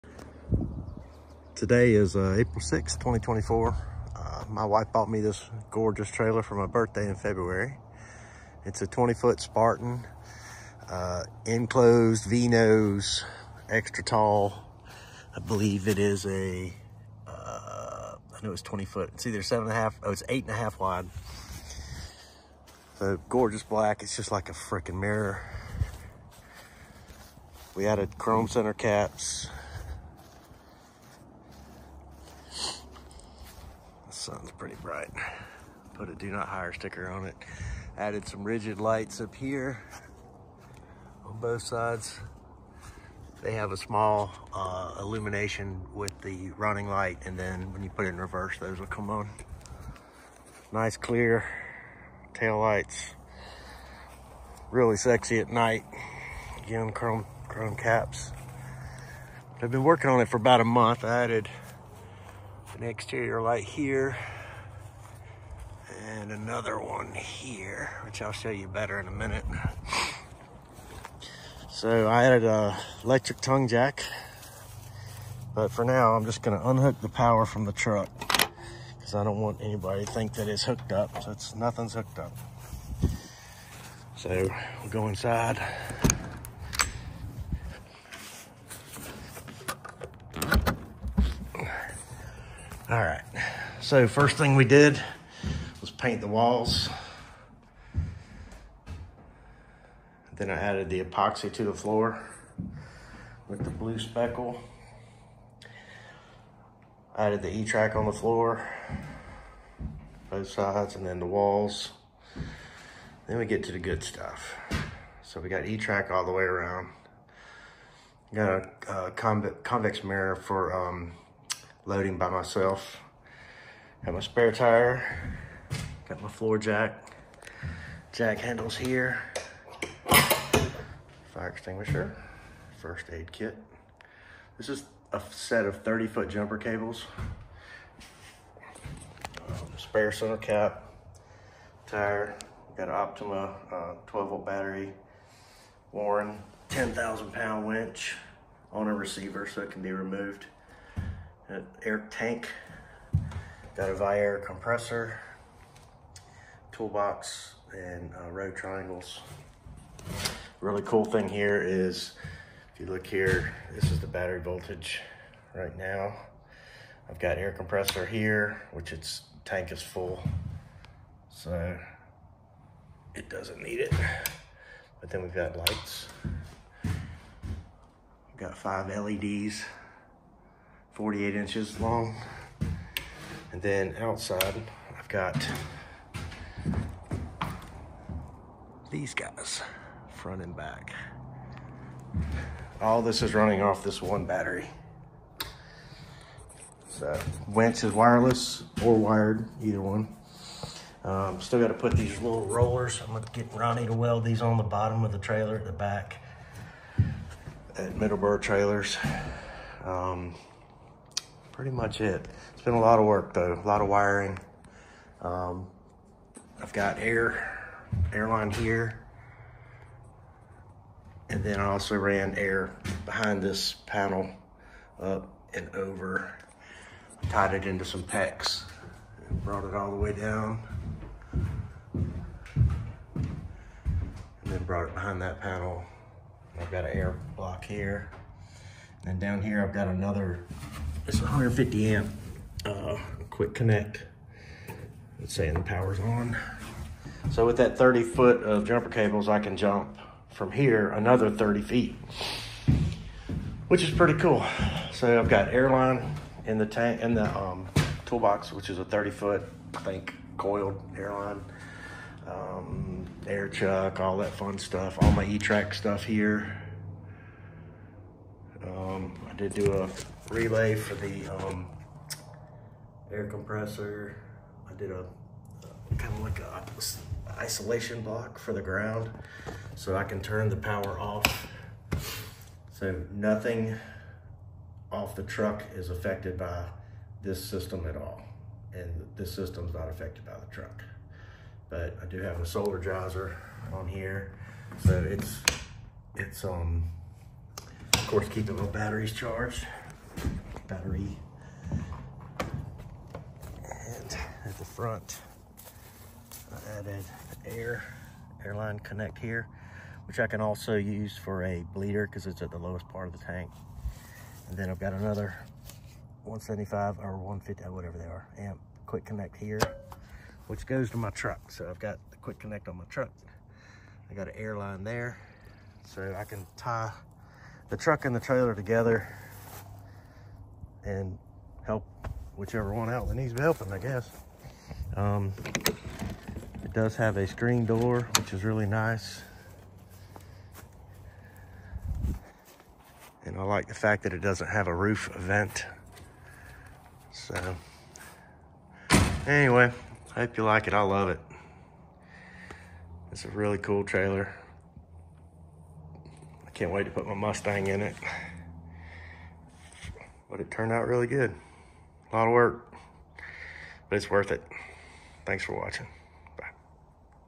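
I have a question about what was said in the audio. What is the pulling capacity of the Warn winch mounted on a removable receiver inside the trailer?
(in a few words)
10,000 pounds.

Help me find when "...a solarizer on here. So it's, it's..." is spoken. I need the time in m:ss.
4:52.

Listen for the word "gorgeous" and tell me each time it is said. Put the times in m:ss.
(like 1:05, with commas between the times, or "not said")
0:05, 0:23.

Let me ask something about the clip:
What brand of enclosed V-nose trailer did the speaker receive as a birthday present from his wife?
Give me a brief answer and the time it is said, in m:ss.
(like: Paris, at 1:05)
Spartan, at 0:09.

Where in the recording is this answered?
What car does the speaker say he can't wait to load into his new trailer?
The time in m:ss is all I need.
5:57.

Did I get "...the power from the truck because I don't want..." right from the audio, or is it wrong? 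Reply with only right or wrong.
right.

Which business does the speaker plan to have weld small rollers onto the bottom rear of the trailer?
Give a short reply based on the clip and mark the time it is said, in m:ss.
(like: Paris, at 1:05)
Middleburg Trailers, at 3:27.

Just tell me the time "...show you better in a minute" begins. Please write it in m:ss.
1:08.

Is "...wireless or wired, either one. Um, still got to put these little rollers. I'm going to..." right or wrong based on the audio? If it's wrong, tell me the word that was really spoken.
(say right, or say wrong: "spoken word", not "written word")
right.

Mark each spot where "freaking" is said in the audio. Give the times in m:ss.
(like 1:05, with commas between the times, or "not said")
0:24.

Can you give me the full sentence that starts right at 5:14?
And then I've got another 175 or 150, or uh, whatever they are, amp quick connect here, which goes to my truck.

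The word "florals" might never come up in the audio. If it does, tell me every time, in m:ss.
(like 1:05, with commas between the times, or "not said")
not said.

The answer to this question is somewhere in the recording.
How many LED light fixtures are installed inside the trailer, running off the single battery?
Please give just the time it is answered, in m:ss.
2:58.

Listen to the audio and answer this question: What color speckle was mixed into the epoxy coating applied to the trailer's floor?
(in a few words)
Blue.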